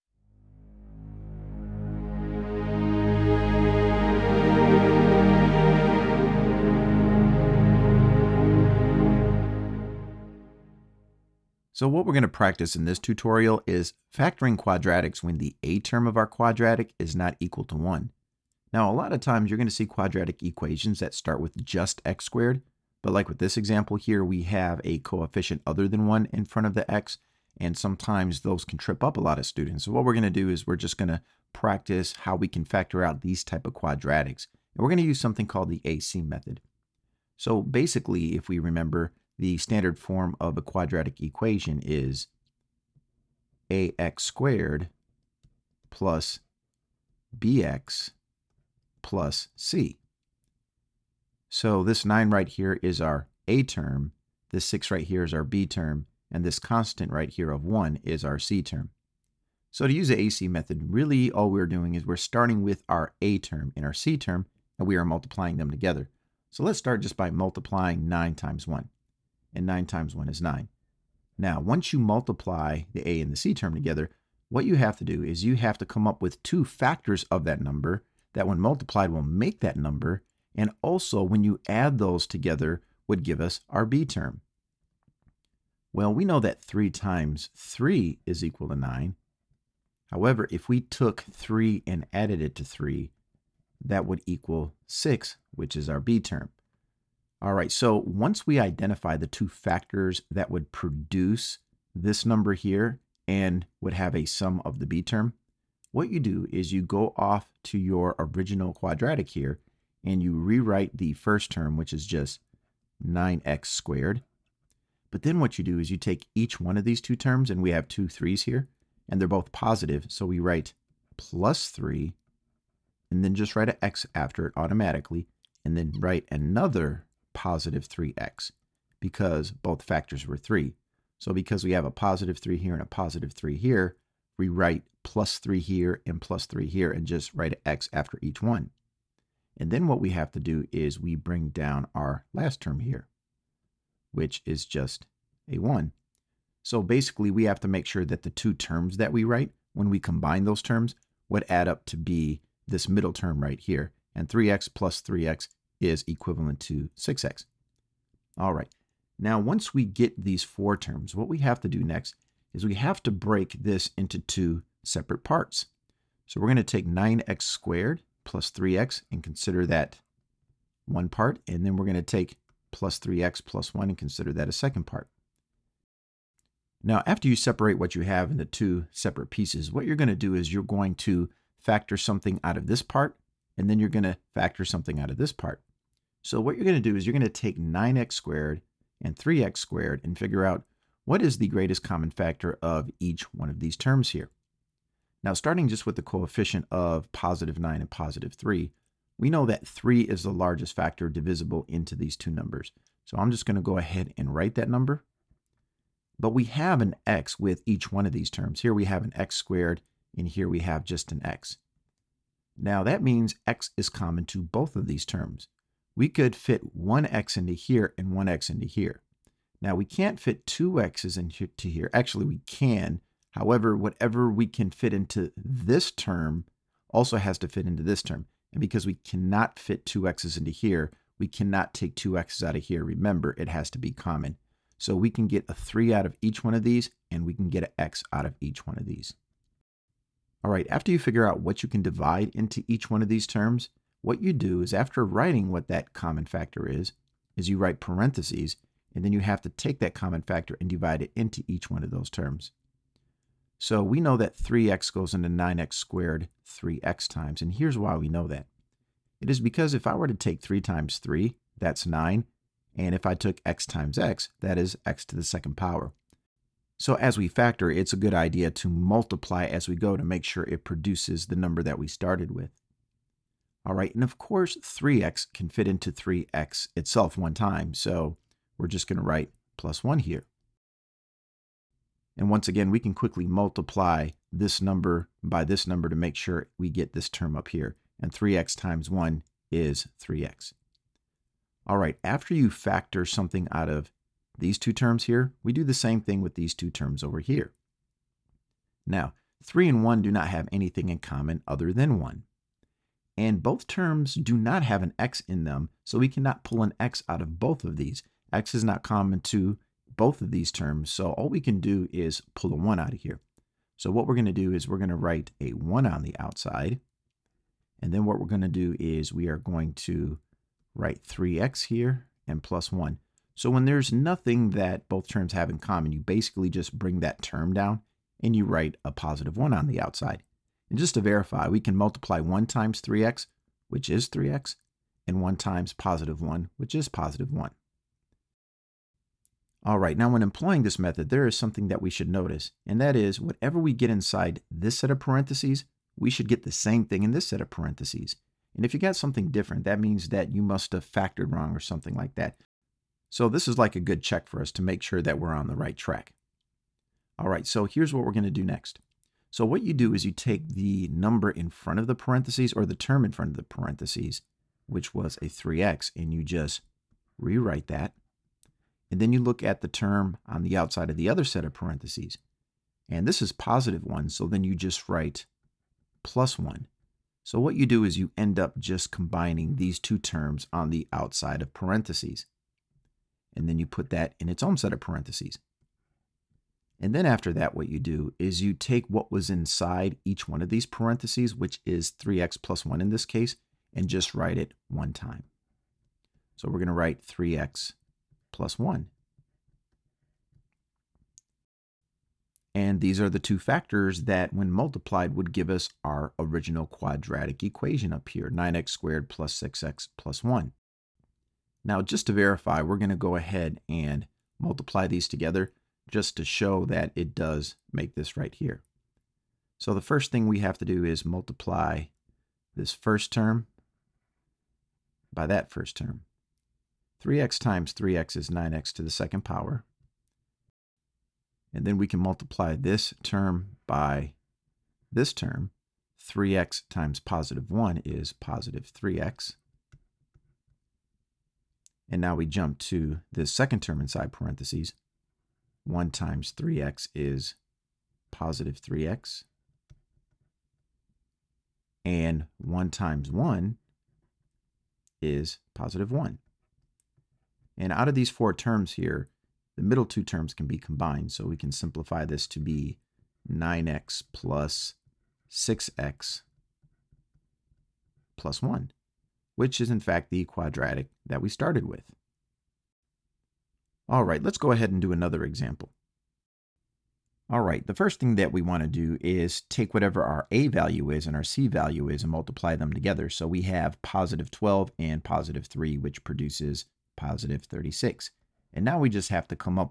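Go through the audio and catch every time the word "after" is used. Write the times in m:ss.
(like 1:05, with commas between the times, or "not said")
2:04, 2:17, 2:57, 4:00, 4:04, 4:52, 6:27.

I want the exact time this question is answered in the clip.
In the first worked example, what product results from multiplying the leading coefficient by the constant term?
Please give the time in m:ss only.
1:09.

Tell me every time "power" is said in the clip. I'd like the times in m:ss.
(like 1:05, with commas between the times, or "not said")
4:25, 7:09.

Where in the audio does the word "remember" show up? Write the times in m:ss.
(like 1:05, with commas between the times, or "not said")
0:38, 3:52.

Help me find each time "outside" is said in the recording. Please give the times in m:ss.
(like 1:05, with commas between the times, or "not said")
5:16, 5:29, 6:10, 6:20.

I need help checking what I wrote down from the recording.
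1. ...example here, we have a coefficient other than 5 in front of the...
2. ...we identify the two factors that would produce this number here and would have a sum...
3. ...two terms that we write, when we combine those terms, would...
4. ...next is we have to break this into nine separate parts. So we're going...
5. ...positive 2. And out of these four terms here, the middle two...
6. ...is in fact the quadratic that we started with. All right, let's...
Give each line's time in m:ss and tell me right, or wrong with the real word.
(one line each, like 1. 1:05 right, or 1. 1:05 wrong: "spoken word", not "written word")
1. 0:23 wrong: "1", not "5"
2. 1:38 right
3. 2:28 right
4. 2:41 wrong: "two", not "nine"
5. 7:35 wrong: "1", not "2"
6. 7:49 right.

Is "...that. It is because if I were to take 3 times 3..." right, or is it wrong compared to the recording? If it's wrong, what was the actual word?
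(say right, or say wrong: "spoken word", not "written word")
right.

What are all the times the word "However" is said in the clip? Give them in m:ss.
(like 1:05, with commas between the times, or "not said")
1:30, 3:43.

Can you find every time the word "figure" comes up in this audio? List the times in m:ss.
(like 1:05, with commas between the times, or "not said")
3:10, 4:00.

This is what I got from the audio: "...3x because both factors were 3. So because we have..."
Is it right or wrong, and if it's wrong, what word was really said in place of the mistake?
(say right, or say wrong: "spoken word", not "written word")
right.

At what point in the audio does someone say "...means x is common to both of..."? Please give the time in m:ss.
3:33.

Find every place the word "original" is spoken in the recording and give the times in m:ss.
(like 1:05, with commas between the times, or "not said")
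1:48, 6:46.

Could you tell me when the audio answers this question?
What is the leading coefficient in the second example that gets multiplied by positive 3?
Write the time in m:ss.
8:03.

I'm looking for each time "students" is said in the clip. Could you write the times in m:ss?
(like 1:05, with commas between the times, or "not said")
0:29.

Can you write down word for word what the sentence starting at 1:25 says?
Well, we know that 3 times 3 is equal to 9.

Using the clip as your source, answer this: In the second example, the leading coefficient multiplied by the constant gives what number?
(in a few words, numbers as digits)
36.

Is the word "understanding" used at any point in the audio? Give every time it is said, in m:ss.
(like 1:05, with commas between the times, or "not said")
not said.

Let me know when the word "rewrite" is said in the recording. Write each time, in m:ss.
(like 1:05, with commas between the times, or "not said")
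1:50, 6:07.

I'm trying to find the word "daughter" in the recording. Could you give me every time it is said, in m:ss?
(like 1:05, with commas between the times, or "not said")
not said.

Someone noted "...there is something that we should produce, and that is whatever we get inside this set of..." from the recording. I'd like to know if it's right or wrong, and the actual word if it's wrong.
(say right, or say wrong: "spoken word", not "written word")
wrong: "notice", not "produce".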